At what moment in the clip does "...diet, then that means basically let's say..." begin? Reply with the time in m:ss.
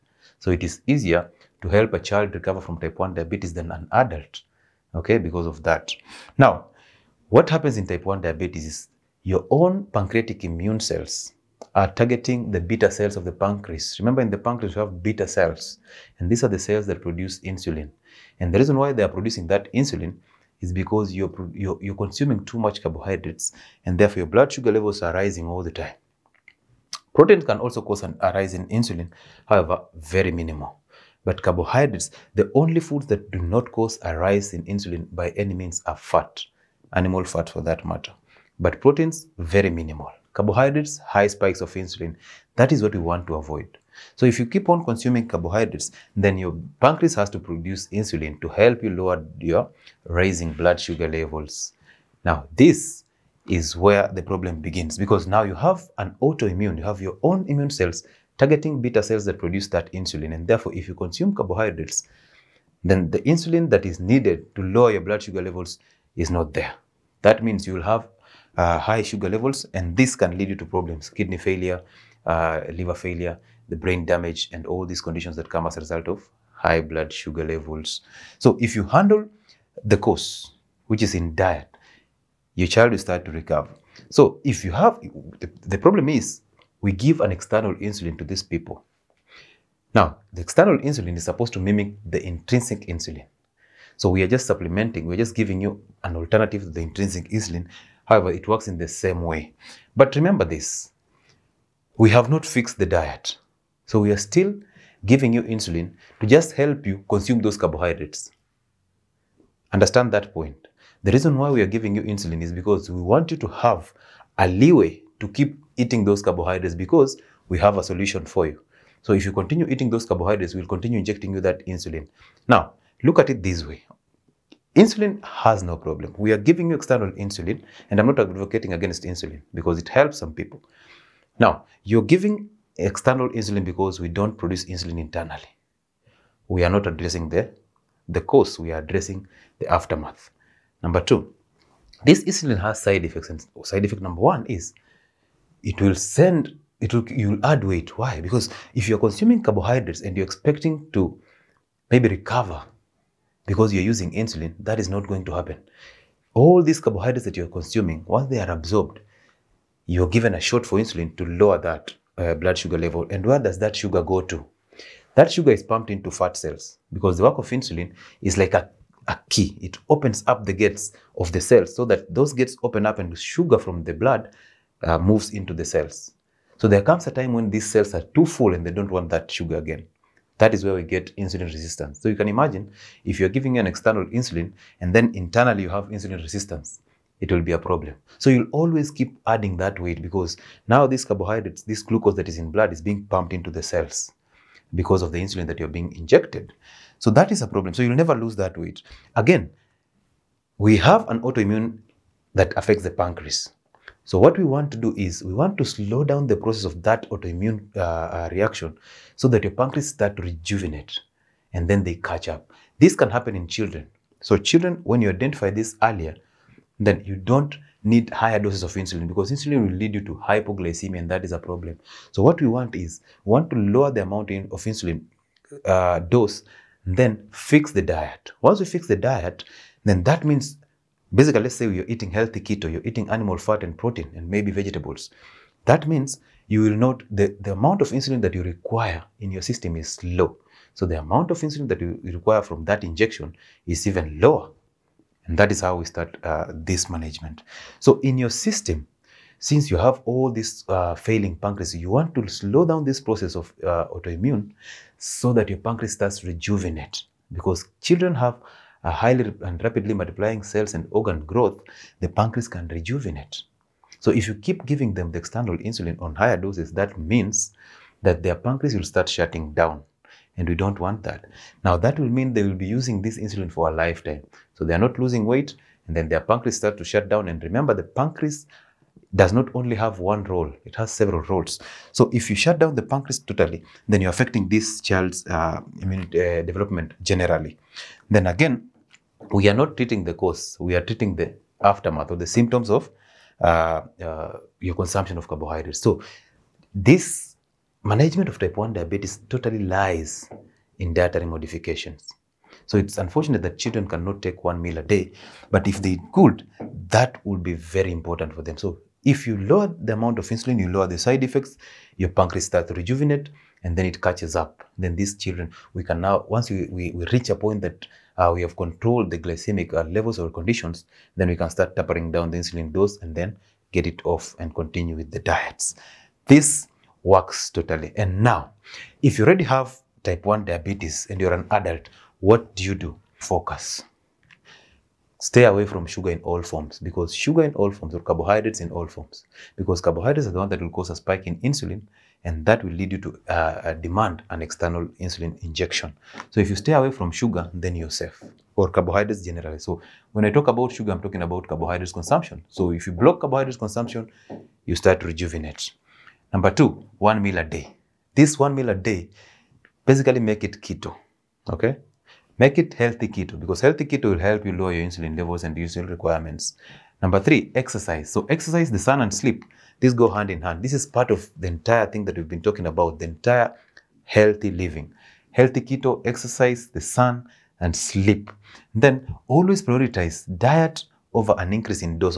3:48.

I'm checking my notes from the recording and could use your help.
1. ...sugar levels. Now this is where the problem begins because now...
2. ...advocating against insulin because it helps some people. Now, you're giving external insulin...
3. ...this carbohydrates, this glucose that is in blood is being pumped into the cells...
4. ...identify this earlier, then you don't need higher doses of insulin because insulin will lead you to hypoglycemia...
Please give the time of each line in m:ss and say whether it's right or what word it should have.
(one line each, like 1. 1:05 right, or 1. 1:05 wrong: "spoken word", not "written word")
1. 0:50 right
2. 2:08 right
3. 3:10 right
4. 3:35 right.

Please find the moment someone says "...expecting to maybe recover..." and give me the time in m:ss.
2:30.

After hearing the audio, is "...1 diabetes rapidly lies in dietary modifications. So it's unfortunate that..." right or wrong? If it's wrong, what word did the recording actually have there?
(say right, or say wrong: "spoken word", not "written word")
wrong: "totally", not "rapidly".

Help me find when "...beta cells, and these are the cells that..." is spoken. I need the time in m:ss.
0:15.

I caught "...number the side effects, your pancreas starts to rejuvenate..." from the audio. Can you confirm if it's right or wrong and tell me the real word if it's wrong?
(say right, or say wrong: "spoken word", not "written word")
wrong: "lower", not "number".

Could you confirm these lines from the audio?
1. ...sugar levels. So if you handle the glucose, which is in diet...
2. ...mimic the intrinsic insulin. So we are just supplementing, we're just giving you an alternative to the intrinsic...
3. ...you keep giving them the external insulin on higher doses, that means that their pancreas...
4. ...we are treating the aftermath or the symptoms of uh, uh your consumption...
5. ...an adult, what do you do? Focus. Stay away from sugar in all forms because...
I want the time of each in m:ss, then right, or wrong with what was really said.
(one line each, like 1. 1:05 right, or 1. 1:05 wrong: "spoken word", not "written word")
1. 1:17 wrong: "cause", not "glucose"
2. 1:31 right
3. 4:24 right
4. 4:50 right
5. 5:31 right.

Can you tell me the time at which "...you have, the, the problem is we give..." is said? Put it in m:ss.
1:24.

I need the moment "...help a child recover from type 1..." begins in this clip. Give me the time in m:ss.
0:01.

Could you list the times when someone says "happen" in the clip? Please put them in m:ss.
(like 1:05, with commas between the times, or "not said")
0:07, 2:35, 3:33.